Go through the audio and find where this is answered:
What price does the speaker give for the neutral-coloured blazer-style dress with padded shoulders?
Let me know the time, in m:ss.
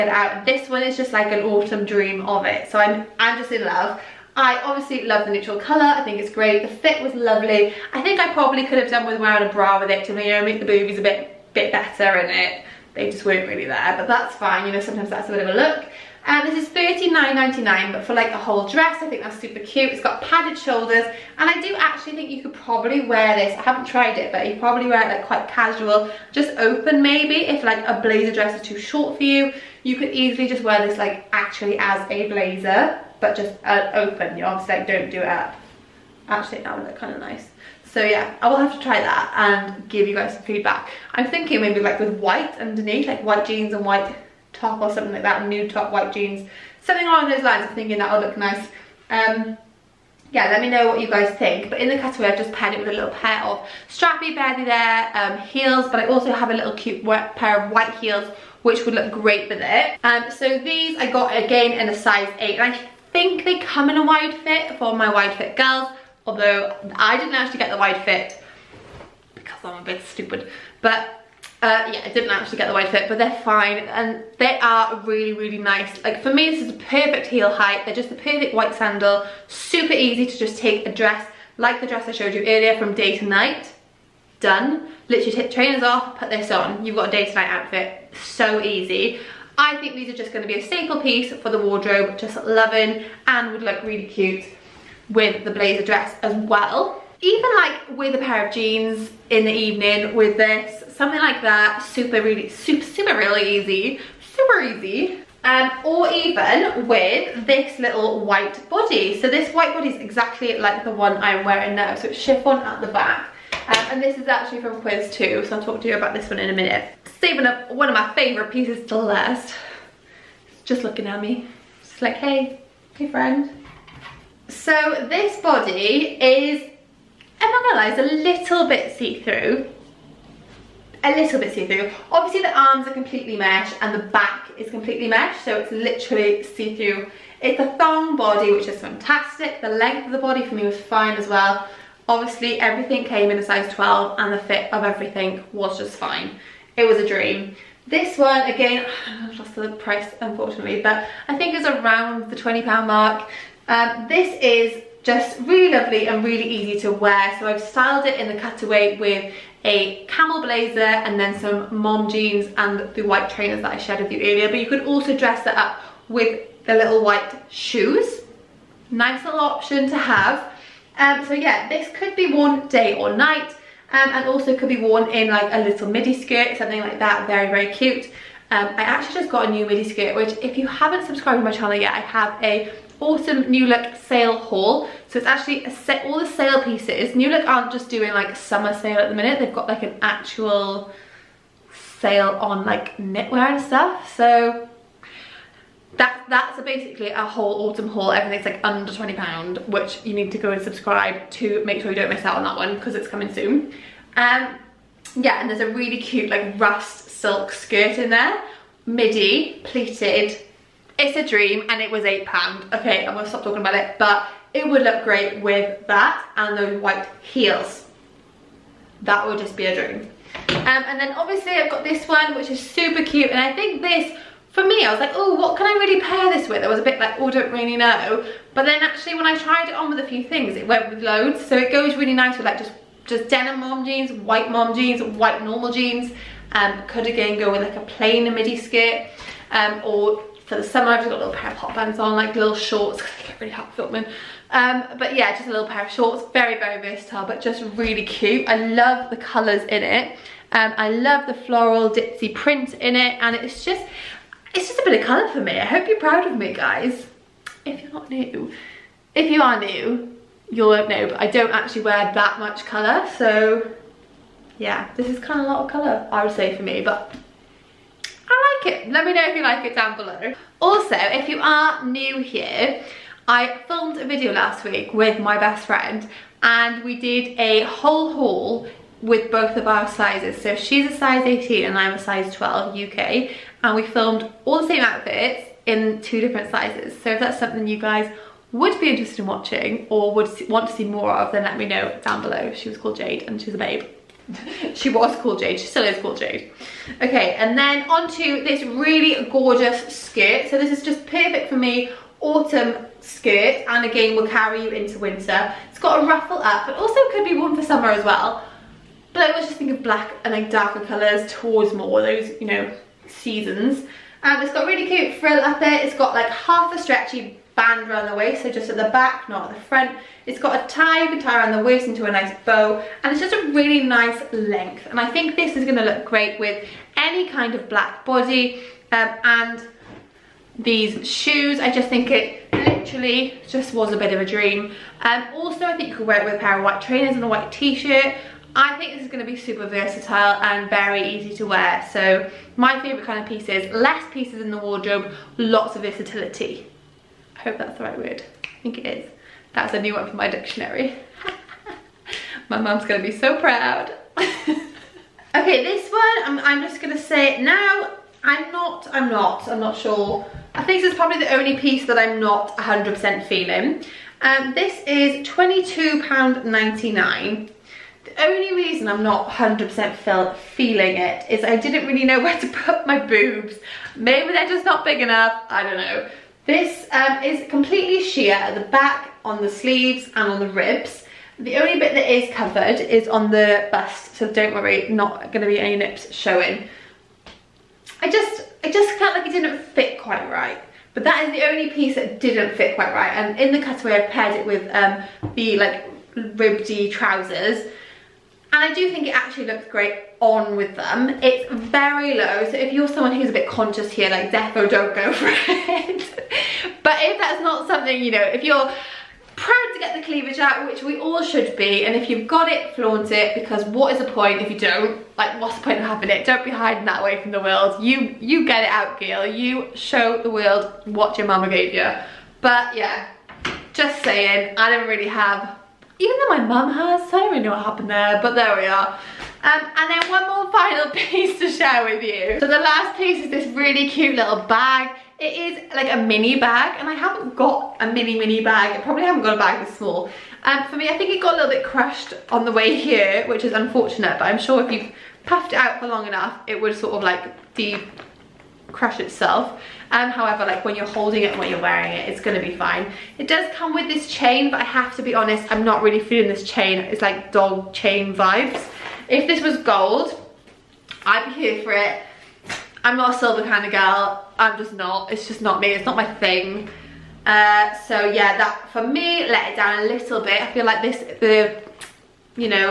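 0:16.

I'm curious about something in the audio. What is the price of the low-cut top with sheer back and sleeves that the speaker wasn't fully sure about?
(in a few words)
£22.99.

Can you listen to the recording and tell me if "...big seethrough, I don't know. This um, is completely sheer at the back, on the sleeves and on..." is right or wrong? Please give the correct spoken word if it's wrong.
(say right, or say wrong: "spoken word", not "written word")
wrong: "enough", not "seethrough".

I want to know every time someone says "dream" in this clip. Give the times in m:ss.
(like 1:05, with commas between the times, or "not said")
0:01, 2:27, 3:31, 3:39, 5:34.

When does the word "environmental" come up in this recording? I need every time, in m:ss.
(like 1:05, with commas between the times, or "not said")
not said.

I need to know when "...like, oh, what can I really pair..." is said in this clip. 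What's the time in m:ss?
3:44.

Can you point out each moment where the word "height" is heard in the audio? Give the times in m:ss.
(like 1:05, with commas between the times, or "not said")
1:17.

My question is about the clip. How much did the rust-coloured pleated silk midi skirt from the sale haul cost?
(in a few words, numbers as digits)
£8.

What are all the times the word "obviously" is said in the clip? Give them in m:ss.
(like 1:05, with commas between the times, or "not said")
0:04, 0:34, 2:12, 2:22, 3:41.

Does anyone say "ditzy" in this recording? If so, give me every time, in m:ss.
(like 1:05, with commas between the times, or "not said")
4:11.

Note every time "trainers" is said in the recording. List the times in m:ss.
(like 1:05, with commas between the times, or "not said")
1:25, 2:43, 5:36.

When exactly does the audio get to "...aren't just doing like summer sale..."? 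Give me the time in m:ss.
3:07.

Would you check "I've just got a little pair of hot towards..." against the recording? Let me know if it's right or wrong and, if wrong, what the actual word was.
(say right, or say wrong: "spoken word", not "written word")
wrong: "bands", not "towards".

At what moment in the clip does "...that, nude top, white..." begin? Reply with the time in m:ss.
0:45.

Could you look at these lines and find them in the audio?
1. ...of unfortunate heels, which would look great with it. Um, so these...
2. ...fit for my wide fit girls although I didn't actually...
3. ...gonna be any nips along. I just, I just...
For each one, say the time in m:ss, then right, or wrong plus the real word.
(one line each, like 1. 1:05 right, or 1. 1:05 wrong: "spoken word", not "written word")
1. 0:57 wrong: "white", not "unfortunate"
2. 1:04 right
3. 6:25 wrong: "showing", not "along".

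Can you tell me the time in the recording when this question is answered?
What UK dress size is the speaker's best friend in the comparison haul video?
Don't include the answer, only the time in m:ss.
4:41.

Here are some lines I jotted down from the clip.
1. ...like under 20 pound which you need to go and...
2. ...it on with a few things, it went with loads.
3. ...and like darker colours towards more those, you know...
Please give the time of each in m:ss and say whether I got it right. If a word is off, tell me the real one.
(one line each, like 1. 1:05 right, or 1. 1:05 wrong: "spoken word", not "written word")
1. 3:18 right
2. 3:49 right
3. 5:10 right.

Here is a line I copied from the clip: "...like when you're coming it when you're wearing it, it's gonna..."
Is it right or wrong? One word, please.
wrong.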